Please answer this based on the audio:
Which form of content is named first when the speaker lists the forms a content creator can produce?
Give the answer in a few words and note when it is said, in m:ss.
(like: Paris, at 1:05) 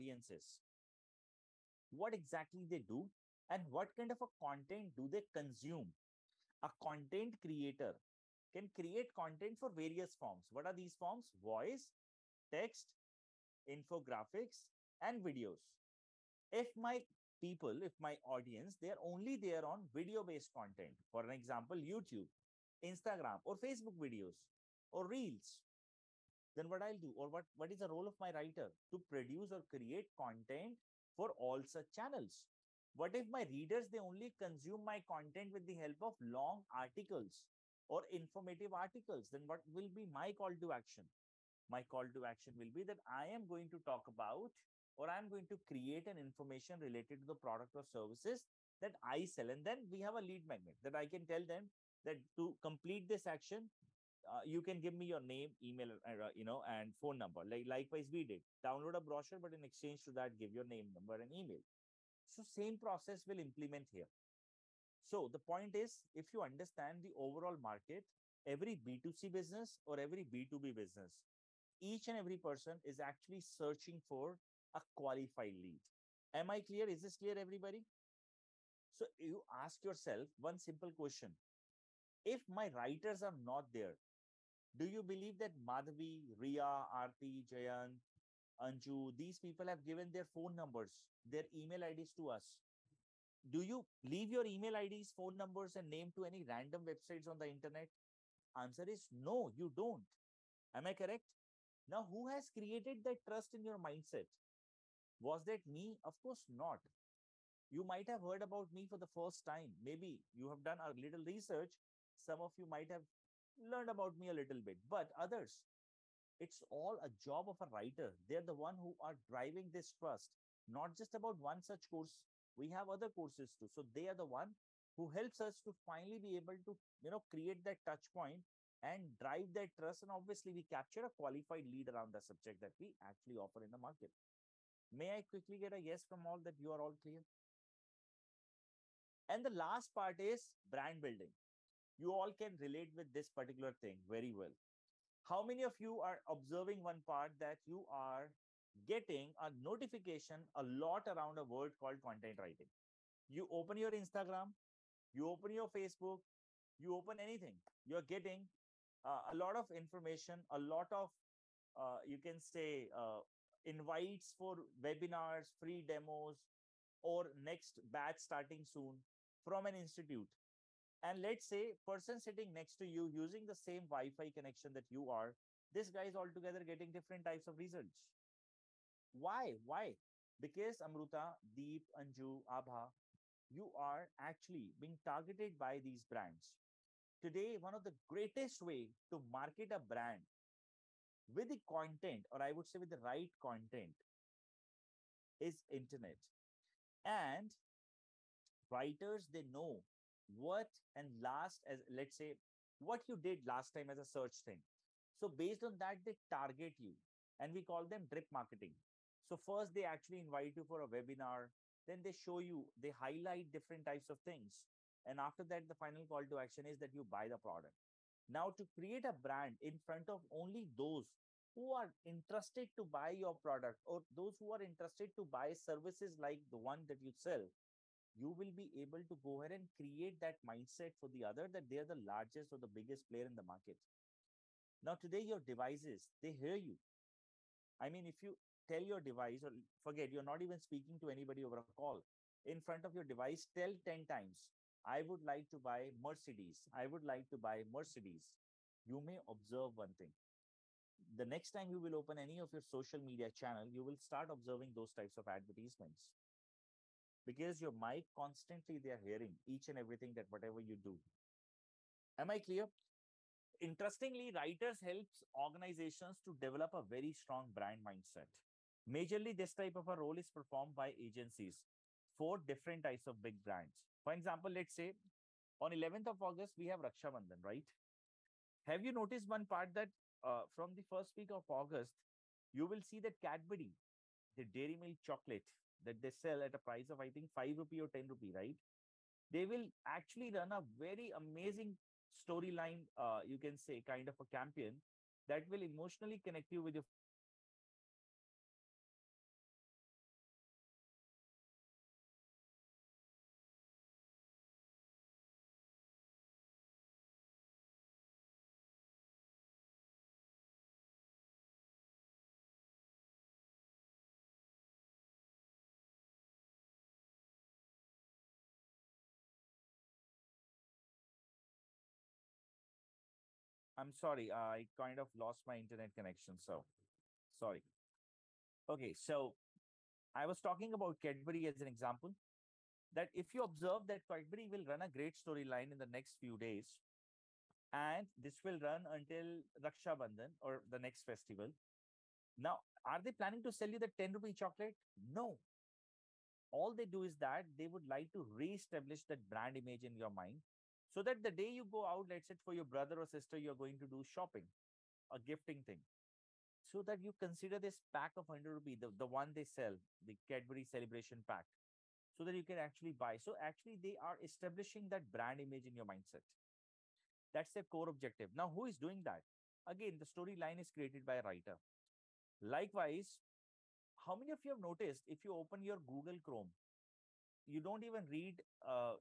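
Voice, at 0:11.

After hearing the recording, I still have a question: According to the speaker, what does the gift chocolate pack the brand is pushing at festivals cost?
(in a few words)
100 rupees.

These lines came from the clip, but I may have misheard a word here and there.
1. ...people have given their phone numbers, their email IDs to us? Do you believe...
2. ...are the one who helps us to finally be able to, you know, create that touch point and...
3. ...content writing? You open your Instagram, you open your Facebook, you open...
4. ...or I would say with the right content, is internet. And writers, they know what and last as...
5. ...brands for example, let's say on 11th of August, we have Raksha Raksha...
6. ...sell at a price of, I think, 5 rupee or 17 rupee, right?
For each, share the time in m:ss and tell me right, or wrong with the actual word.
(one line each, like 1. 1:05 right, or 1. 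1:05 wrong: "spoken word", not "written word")
1. 1:29 wrong: "leave", not "believe"
2. 2:04 right
3. 2:32 right
4. 3:12 right
5. 4:33 wrong: "Bandhan", not "Raksha"
6. 4:46 wrong: "10", not "17".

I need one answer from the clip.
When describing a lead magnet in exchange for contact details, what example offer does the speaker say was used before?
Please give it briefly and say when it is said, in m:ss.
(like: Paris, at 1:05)
Download a brochure, at 0:58.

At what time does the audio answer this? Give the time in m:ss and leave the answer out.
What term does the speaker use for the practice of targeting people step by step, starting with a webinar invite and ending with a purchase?
3:28.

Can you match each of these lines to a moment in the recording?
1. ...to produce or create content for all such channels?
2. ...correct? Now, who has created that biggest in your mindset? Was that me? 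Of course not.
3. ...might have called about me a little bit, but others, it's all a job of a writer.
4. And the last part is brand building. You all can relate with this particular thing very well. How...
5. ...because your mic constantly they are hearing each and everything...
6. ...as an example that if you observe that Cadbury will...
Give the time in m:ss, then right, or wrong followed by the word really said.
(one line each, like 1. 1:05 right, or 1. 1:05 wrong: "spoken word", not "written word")
1. 0:28 right
2. 1:40 wrong: "trust", not "biggest"
3. 1:52 wrong: "learned", not "called"
4. 2:19 right
5. 4:17 right
6. 5:31 right.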